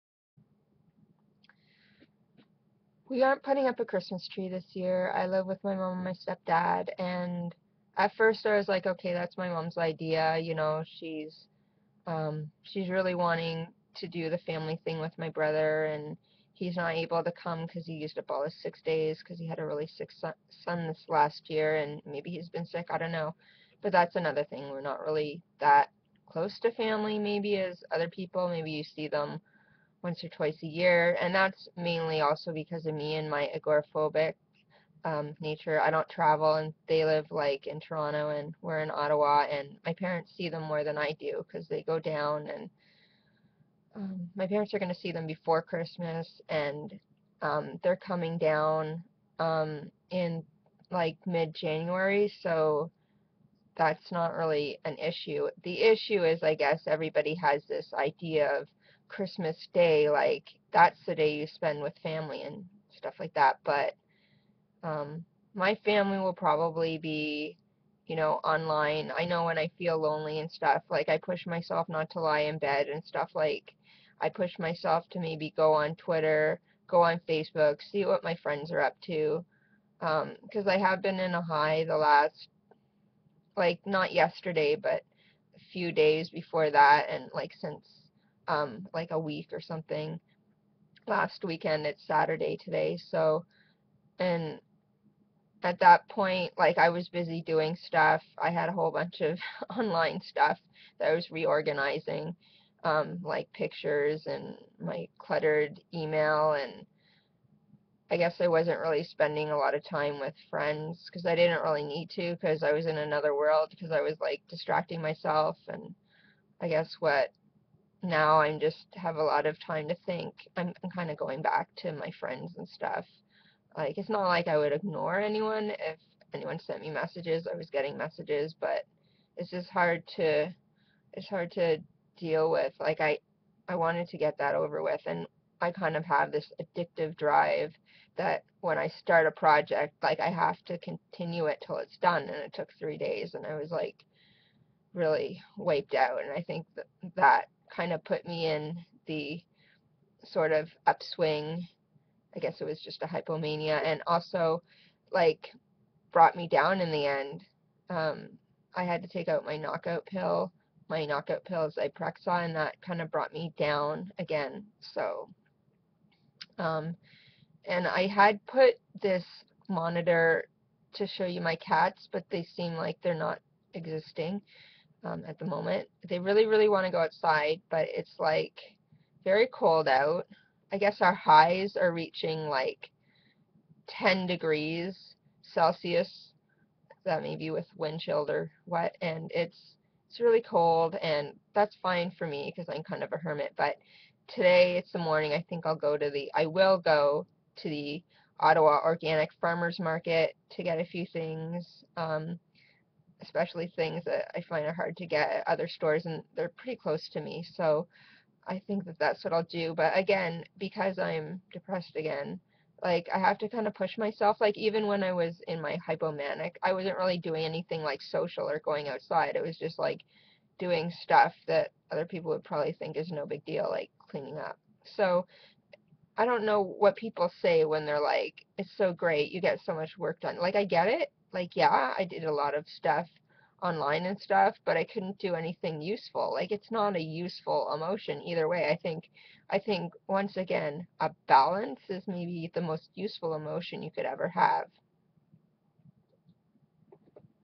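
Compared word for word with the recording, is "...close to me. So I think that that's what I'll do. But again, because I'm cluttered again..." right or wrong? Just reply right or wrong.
wrong.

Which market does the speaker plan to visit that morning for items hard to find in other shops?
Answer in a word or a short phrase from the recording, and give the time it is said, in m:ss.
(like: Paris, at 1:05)
Ottawa Organic Farmers Market, at 3:18.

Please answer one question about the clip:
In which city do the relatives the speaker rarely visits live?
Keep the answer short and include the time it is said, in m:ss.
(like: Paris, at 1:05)
Toronto, at 0:37.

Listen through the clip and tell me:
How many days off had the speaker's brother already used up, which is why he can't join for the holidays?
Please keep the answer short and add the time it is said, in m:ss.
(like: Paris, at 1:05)
6, at 0:18.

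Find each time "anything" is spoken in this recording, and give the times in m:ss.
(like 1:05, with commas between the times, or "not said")
3:37, 3:55.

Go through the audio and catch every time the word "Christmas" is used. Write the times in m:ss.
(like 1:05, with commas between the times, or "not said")
0:03, 0:45, 0:59.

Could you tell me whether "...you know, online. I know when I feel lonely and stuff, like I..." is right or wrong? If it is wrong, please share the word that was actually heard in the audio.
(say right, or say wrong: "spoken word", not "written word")
right.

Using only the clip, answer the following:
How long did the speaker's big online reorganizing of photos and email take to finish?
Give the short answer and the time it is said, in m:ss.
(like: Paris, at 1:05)
3 days, at 2:22.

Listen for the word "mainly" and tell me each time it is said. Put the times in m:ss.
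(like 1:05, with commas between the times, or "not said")
0:31.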